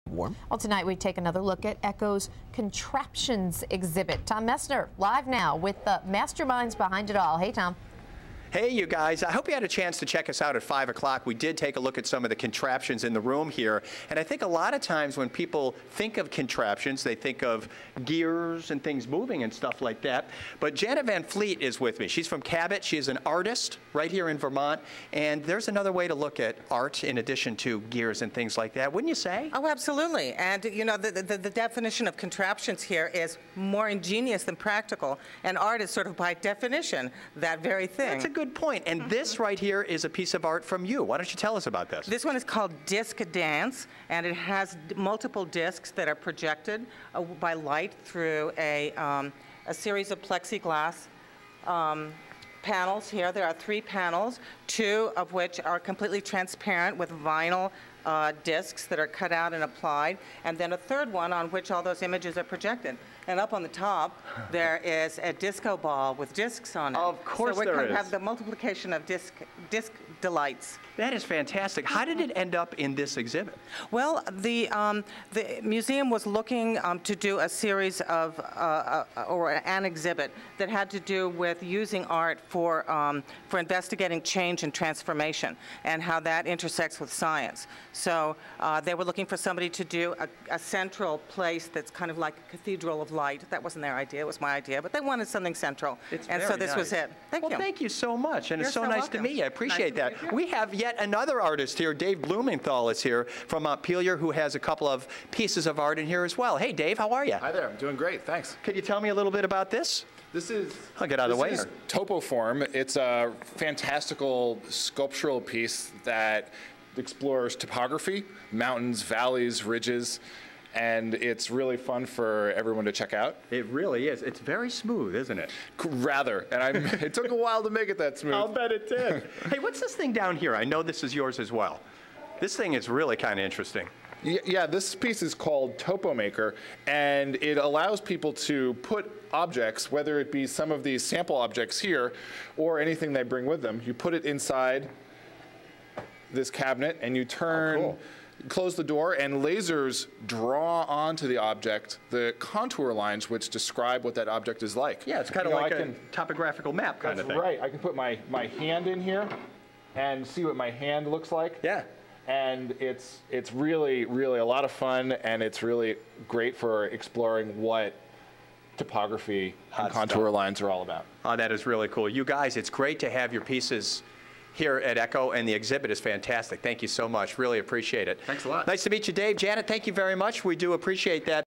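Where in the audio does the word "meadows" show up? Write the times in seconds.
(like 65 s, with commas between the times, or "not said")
not said.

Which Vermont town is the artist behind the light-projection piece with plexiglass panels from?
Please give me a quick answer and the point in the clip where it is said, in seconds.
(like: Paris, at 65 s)
Cabot, at 22 s.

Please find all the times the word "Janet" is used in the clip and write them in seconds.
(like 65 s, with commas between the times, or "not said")
20 s, 179 s.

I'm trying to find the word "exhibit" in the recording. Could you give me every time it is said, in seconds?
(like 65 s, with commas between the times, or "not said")
3 s, 73 s, 79 s, 175 s.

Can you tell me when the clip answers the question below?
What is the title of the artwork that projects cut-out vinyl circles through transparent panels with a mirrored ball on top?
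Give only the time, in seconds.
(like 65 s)
42 s.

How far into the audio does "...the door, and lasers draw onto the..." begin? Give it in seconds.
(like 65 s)
148 s.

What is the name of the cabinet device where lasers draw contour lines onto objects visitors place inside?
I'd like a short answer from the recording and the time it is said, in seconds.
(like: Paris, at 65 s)
TopoMaker, at 135 s.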